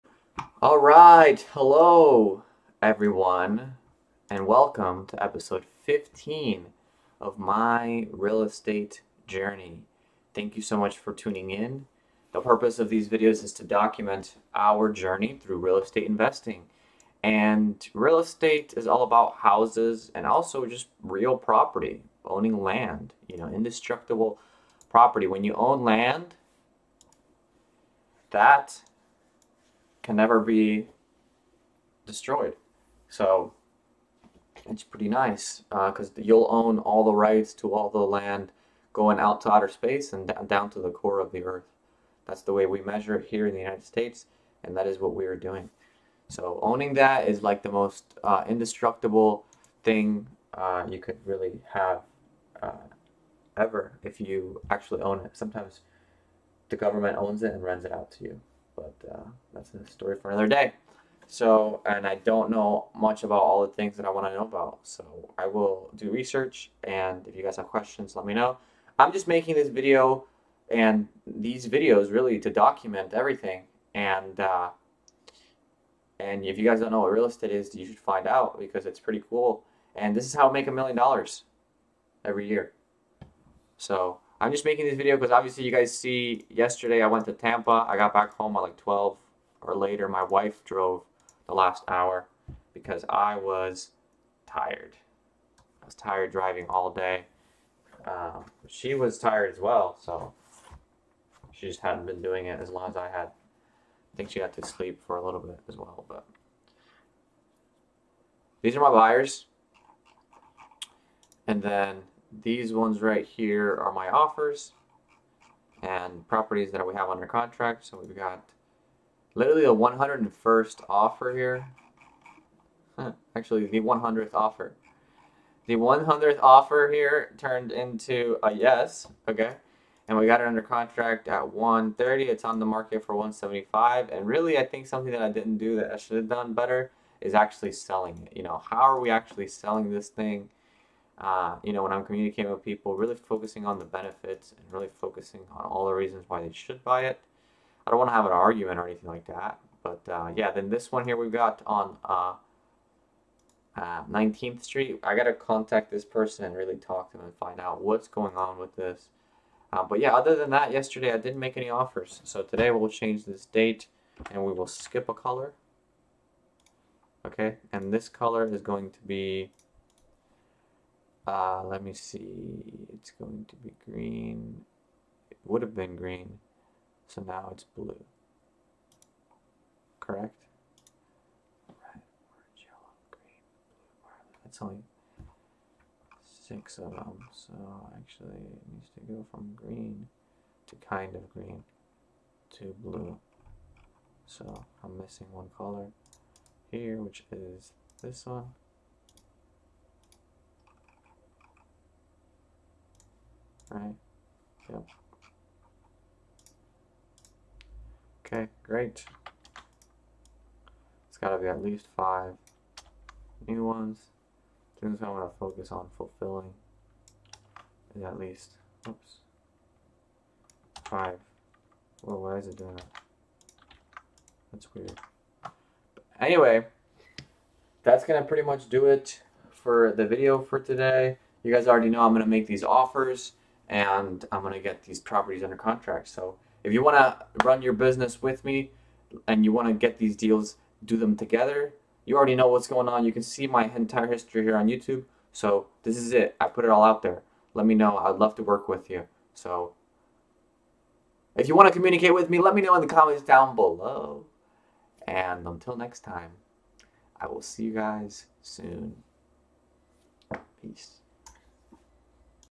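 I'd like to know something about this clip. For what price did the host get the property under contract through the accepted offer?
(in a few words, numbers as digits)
130.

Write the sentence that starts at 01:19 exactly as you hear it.
And this is how I make a million dollars every year.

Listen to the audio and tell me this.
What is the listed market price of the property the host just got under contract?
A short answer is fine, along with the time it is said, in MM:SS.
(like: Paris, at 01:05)
175, at 02:13.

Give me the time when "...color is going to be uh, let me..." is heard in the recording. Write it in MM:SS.
02:48.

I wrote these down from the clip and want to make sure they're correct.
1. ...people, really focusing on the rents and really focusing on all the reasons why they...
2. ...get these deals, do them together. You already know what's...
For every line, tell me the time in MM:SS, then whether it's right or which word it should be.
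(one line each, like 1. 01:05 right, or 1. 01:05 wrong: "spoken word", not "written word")
1. 02:22 wrong: "benefits", not "rents"
2. 03:59 right.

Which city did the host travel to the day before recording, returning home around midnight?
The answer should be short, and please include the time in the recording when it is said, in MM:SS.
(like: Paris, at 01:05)
Tampa, at 01:27.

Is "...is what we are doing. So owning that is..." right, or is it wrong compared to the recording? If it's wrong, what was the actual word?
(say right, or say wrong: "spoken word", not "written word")
right.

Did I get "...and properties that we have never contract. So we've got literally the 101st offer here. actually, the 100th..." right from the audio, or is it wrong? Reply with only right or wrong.
wrong.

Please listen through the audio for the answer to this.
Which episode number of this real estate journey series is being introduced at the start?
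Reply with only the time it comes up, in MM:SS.
00:05.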